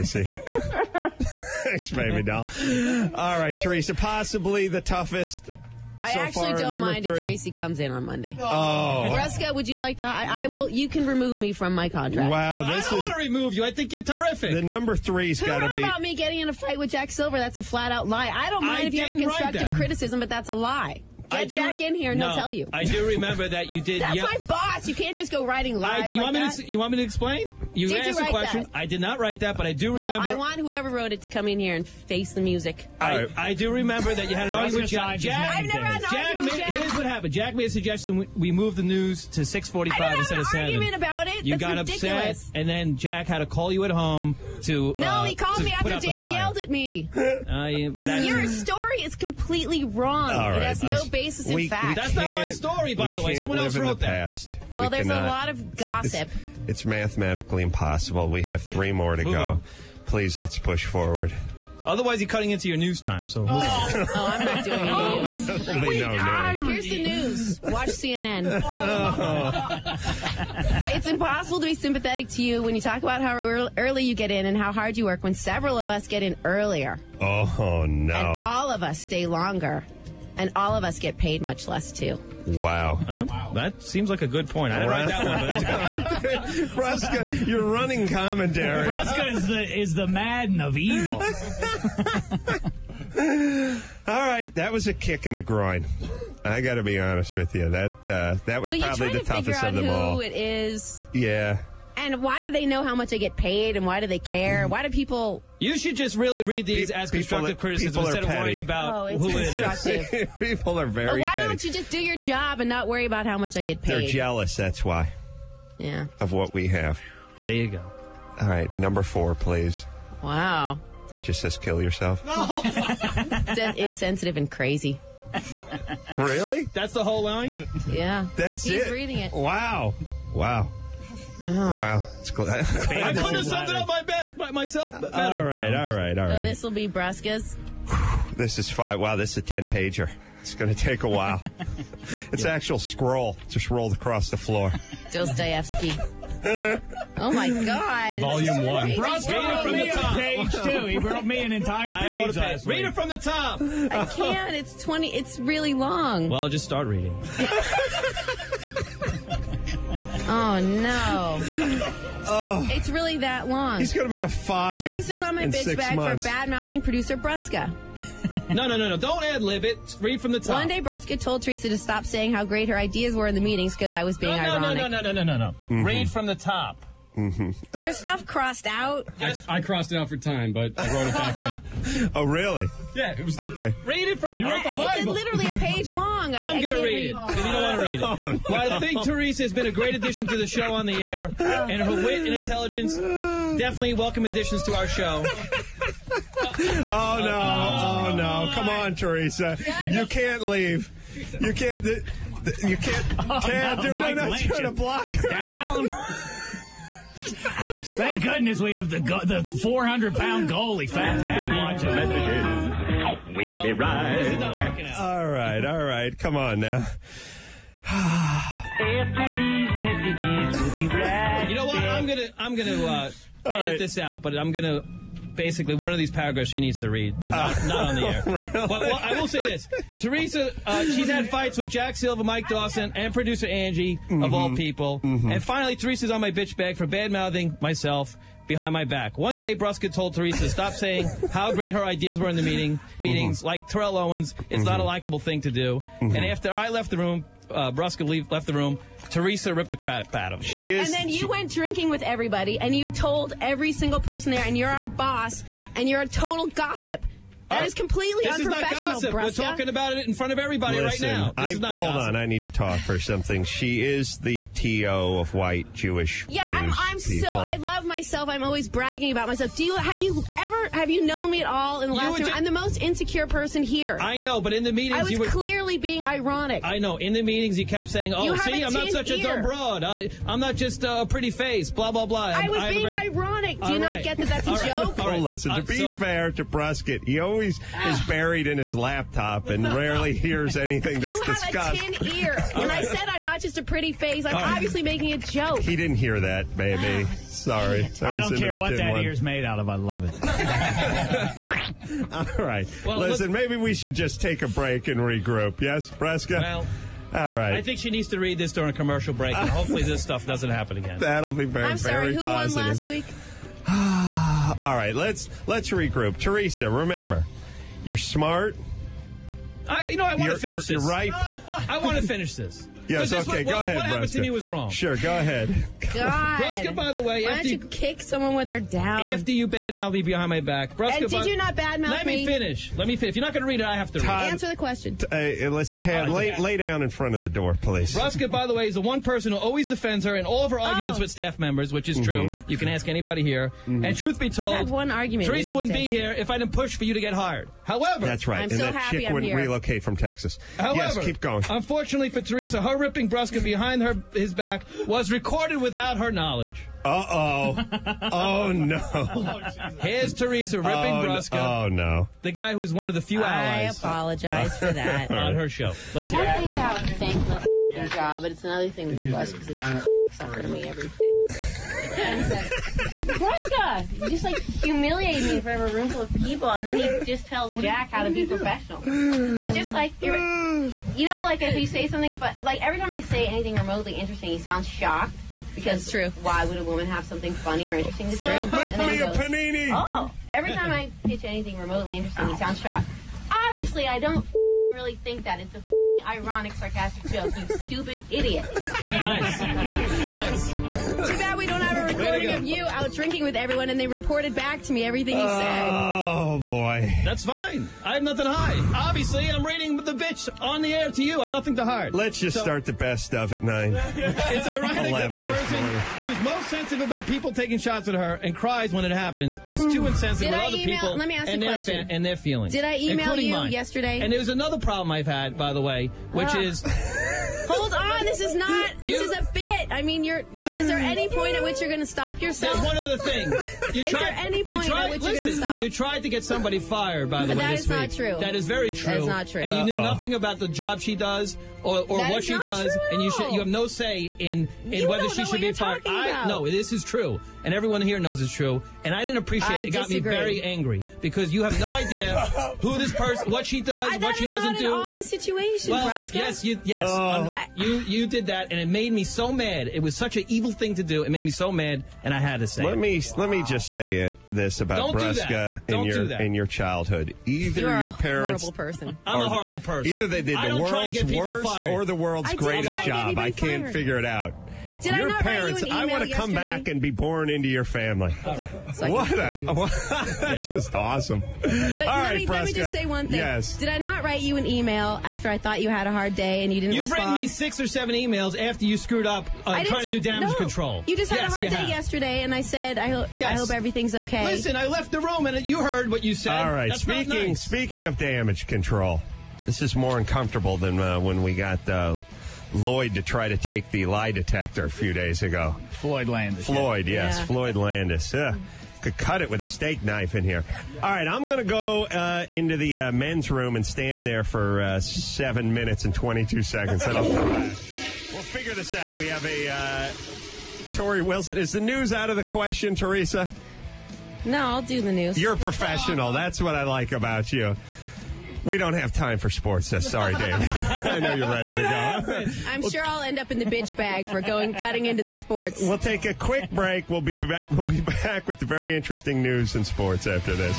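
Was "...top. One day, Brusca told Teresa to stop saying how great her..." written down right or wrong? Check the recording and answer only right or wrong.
right.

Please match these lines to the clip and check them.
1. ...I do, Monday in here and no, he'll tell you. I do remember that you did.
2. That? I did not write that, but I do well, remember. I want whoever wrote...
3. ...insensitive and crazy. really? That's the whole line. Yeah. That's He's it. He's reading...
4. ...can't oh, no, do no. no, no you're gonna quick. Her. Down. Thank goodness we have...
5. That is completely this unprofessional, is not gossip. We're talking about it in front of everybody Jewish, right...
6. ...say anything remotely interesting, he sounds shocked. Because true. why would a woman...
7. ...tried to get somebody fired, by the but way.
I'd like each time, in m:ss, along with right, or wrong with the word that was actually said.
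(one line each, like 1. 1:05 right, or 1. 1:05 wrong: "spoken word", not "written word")
1. 0:21 wrong: "Jack", not "Monday"
2. 0:28 right
3. 2:03 right
4. 3:23 wrong: "block", not "quick"
5. 4:17 wrong: "Listen", not "Jewish"
6. 6:23 right
7. 7:15 right.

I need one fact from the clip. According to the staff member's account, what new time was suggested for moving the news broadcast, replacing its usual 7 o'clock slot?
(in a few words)
6:45.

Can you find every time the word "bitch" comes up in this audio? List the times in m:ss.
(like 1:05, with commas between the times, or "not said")
2:45, 3:56, 6:49, 8:53.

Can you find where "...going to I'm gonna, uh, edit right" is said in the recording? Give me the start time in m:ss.
3:42.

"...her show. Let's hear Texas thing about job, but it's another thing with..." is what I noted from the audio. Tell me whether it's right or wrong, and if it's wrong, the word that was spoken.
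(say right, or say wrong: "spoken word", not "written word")
wrong: "One", not "Texas".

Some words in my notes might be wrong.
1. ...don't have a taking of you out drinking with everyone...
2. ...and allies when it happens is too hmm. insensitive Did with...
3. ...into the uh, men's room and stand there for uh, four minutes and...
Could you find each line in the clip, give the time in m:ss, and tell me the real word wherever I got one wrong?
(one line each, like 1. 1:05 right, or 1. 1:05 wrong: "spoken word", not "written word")
1. 6:41 wrong: "recording", not "taking"
2. 6:58 wrong: "cries", not "allies"
3. 8:32 wrong: "seven", not "four".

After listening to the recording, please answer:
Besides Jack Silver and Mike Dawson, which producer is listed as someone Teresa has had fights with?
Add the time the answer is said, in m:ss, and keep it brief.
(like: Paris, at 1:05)
Angie, at 3:53.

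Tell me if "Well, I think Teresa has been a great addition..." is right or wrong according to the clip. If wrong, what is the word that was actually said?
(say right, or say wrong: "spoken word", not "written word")
right.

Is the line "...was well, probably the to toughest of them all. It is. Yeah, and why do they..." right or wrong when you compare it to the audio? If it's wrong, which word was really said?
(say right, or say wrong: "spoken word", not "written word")
right.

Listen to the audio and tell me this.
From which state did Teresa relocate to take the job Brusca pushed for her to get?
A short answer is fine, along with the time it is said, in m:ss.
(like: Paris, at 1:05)
Texas, at 5:49.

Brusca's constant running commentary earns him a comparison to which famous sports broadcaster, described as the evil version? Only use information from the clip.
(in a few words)
Madden.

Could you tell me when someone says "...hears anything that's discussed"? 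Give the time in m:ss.
4:50.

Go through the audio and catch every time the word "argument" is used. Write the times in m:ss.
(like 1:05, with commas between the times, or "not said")
0:34, 0:40, 5:40, 5:44.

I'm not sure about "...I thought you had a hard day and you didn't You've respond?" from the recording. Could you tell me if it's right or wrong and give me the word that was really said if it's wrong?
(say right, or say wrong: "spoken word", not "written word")
right.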